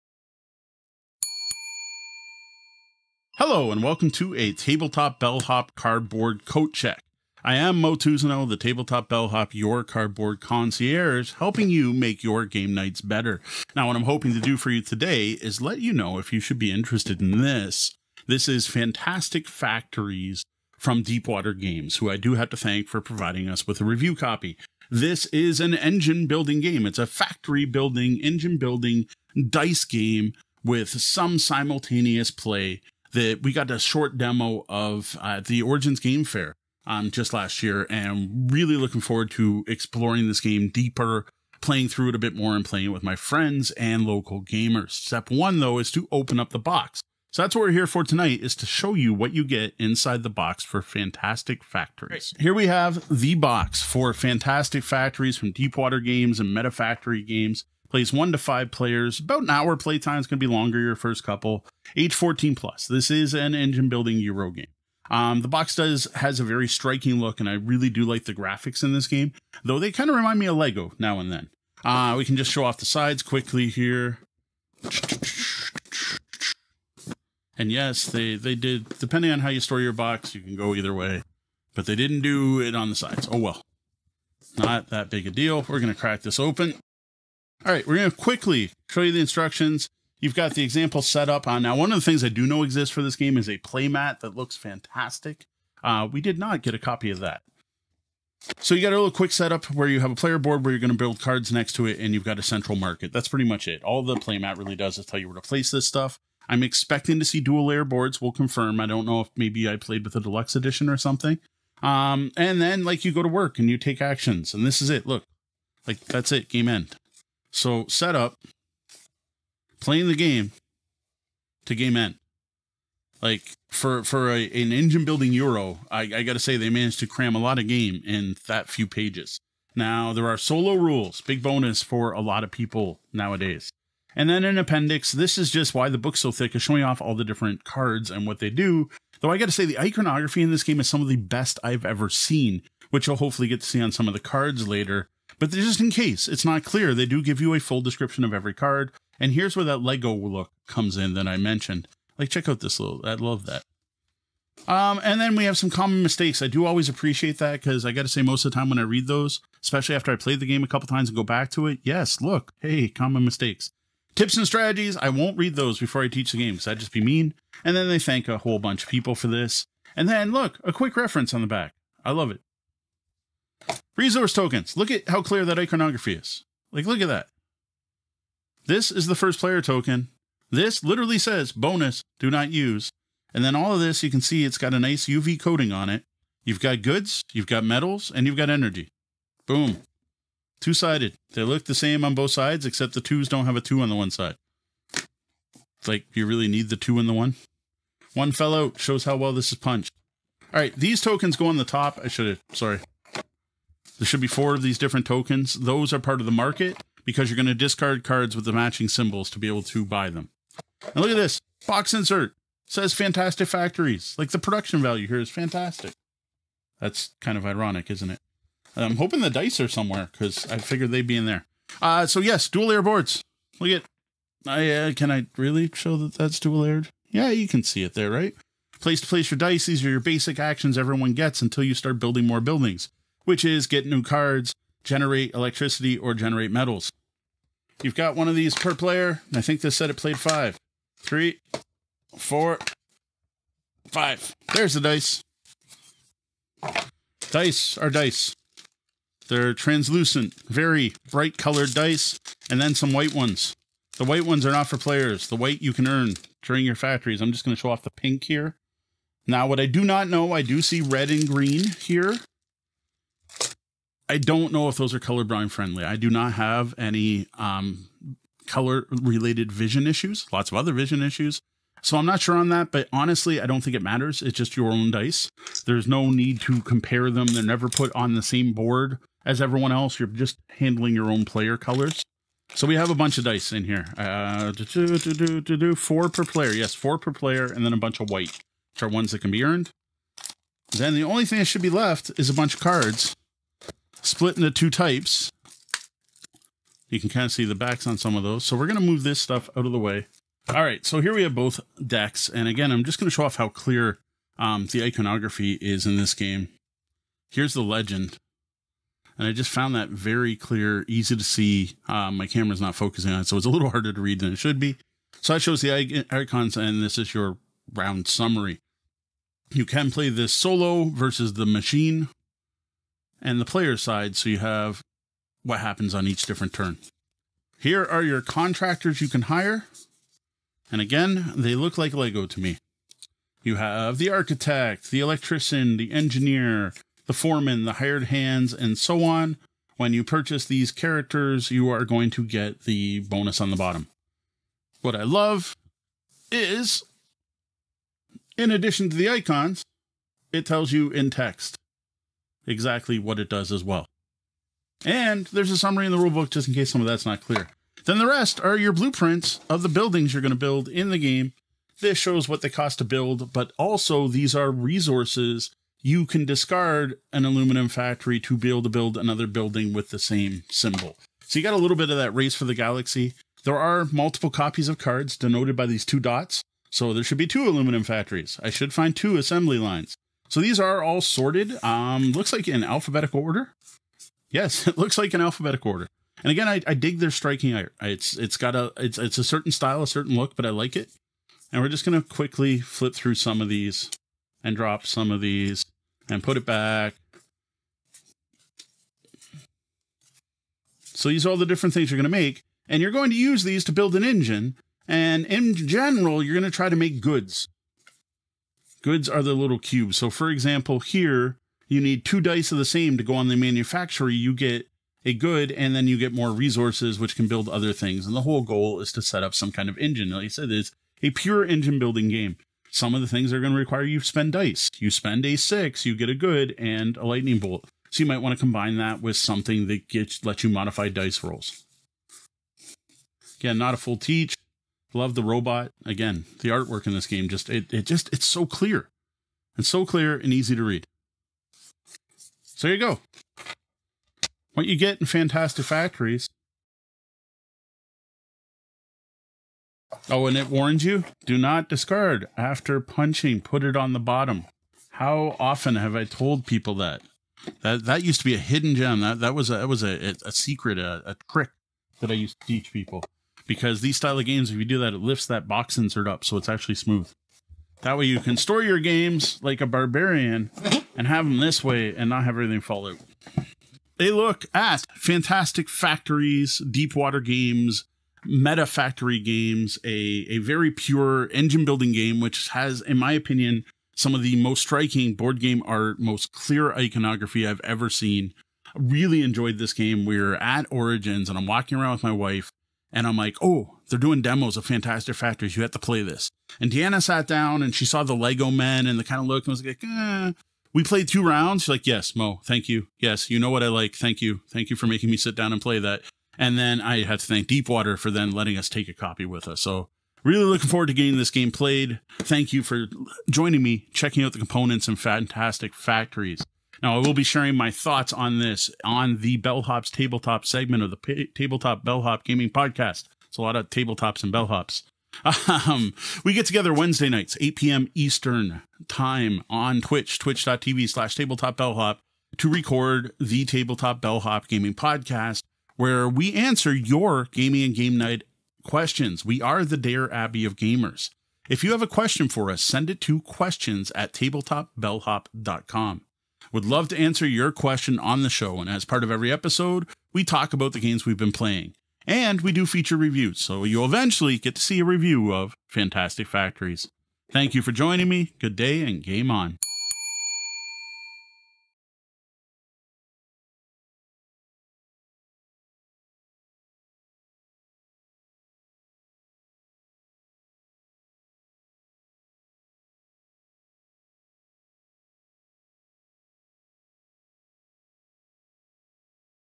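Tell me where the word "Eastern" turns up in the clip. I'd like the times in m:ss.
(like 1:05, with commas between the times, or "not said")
8:47.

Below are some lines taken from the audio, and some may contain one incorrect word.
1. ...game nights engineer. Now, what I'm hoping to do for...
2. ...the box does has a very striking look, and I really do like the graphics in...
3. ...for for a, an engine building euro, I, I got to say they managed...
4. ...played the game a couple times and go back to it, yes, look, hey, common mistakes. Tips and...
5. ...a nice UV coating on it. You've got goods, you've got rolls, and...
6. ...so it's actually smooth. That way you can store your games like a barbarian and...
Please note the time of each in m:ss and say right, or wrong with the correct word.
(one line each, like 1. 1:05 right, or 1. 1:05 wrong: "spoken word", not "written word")
1. 0:12 wrong: "better", not "engineer"
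2. 1:05 right
3. 2:03 right
4. 2:40 right
5. 3:04 wrong: "metals", not "rolls"
6. 7:46 right.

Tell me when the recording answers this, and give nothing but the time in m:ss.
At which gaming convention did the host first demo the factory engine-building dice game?
0:35.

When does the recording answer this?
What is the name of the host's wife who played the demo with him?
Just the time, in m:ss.
8:16.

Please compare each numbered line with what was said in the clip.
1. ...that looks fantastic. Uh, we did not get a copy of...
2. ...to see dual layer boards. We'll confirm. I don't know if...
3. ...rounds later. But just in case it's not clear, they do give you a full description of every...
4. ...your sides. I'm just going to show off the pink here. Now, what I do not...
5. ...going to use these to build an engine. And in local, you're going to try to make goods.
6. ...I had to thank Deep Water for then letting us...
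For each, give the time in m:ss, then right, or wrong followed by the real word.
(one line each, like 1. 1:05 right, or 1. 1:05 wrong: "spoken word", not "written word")
1. 1:34 right
2. 1:47 right
3. 2:24 wrong: "cards", not "rounds"
4. 4:16 wrong: "factories", not "sides"
5. 6:42 wrong: "general", not "local"
6. 8:26 right.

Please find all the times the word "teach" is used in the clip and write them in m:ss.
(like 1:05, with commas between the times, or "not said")
2:46, 7:13, 7:42.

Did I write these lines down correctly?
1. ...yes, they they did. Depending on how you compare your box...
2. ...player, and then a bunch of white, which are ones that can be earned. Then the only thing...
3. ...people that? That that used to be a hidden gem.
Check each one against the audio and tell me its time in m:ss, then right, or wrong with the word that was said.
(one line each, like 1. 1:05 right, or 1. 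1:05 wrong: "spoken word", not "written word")
1. 1:17 wrong: "store", not "compare"
2. 4:47 right
3. 7:36 right.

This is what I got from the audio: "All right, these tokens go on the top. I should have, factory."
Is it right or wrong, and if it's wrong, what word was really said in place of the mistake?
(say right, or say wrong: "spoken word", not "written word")
wrong: "sorry", not "factory".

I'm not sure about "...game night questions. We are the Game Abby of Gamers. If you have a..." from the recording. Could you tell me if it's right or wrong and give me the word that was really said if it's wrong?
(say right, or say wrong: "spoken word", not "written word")
wrong: "Dear", not "Game".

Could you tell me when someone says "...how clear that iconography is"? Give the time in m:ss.
2:55.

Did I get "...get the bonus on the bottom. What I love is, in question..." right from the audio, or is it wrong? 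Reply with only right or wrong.
wrong.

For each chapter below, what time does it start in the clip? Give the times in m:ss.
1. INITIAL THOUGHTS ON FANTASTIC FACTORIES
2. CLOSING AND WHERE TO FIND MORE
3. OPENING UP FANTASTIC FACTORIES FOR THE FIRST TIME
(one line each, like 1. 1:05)
1. 7:53
2. 8:36
3. 0:52.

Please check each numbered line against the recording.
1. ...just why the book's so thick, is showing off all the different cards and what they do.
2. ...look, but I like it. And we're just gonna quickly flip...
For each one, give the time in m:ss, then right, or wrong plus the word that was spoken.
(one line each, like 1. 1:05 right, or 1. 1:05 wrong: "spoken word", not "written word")
1. 2:15 right
2. 6:30 right.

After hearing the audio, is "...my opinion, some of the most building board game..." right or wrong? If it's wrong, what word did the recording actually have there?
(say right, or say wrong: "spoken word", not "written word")
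wrong: "striking", not "building".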